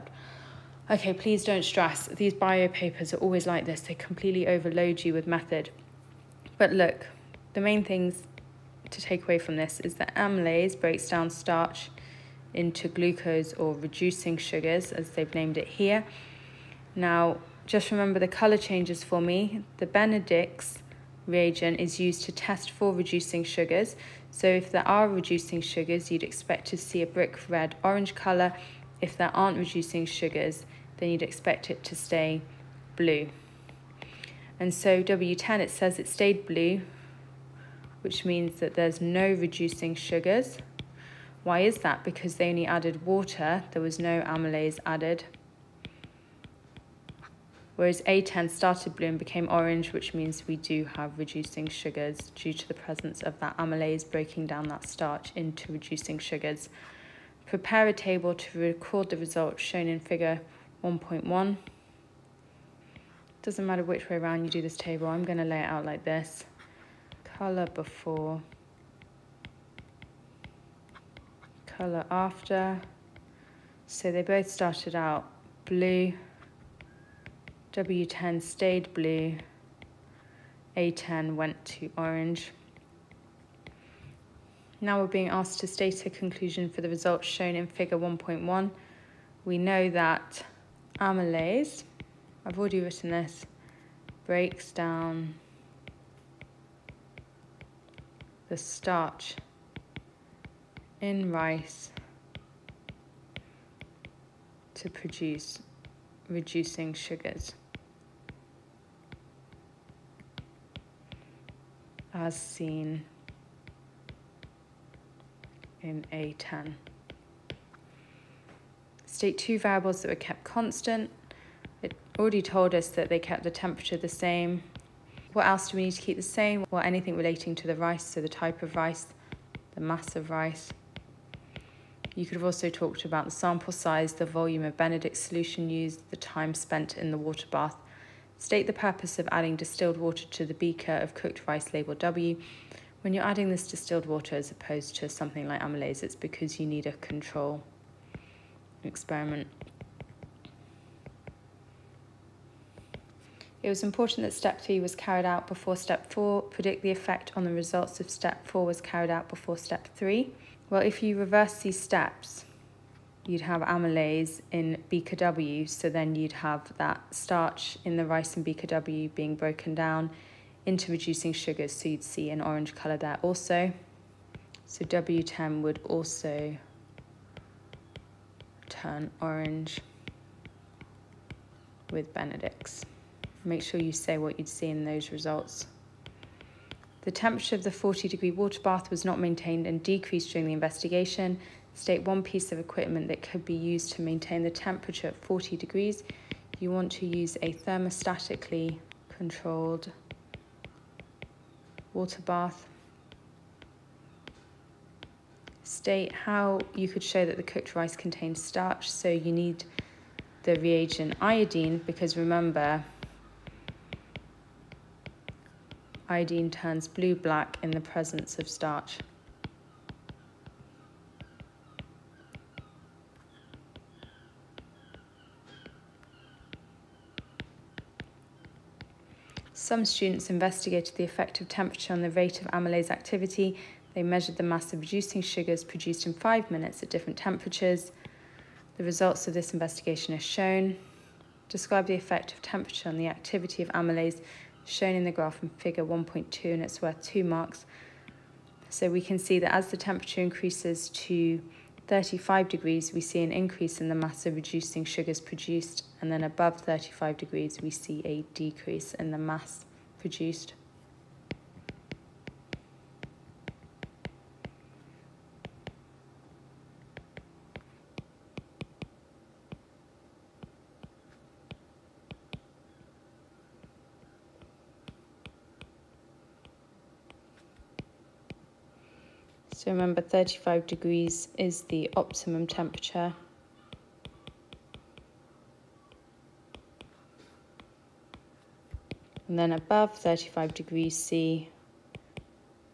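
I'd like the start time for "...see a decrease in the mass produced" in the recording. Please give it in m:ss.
4:17.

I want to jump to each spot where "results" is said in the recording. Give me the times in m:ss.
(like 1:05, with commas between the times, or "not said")
0:59, 1:26, 2:37, 3:05, 3:58.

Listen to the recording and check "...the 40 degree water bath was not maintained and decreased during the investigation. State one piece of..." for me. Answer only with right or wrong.
right.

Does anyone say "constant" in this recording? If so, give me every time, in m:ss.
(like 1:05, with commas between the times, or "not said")
2:00.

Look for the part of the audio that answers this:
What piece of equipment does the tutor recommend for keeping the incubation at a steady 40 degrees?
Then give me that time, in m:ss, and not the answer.
3:17.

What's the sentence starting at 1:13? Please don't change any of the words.
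So they both started out blue, W10 stayed blue, A10 went to orange.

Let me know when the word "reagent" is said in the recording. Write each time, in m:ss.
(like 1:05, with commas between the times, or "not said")
0:21, 3:30.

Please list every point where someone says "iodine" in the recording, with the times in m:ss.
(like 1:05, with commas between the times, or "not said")
3:31, 3:36.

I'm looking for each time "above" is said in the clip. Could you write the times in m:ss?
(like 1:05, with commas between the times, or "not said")
4:16, 4:49.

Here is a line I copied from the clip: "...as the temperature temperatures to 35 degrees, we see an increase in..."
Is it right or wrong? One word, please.
wrong.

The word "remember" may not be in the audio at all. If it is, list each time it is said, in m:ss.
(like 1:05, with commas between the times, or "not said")
0:17, 3:32, 4:39.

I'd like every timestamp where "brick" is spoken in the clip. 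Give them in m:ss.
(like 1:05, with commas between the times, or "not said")
0:27.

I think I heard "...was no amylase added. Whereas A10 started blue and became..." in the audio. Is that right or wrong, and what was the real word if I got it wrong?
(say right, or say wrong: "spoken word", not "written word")
right.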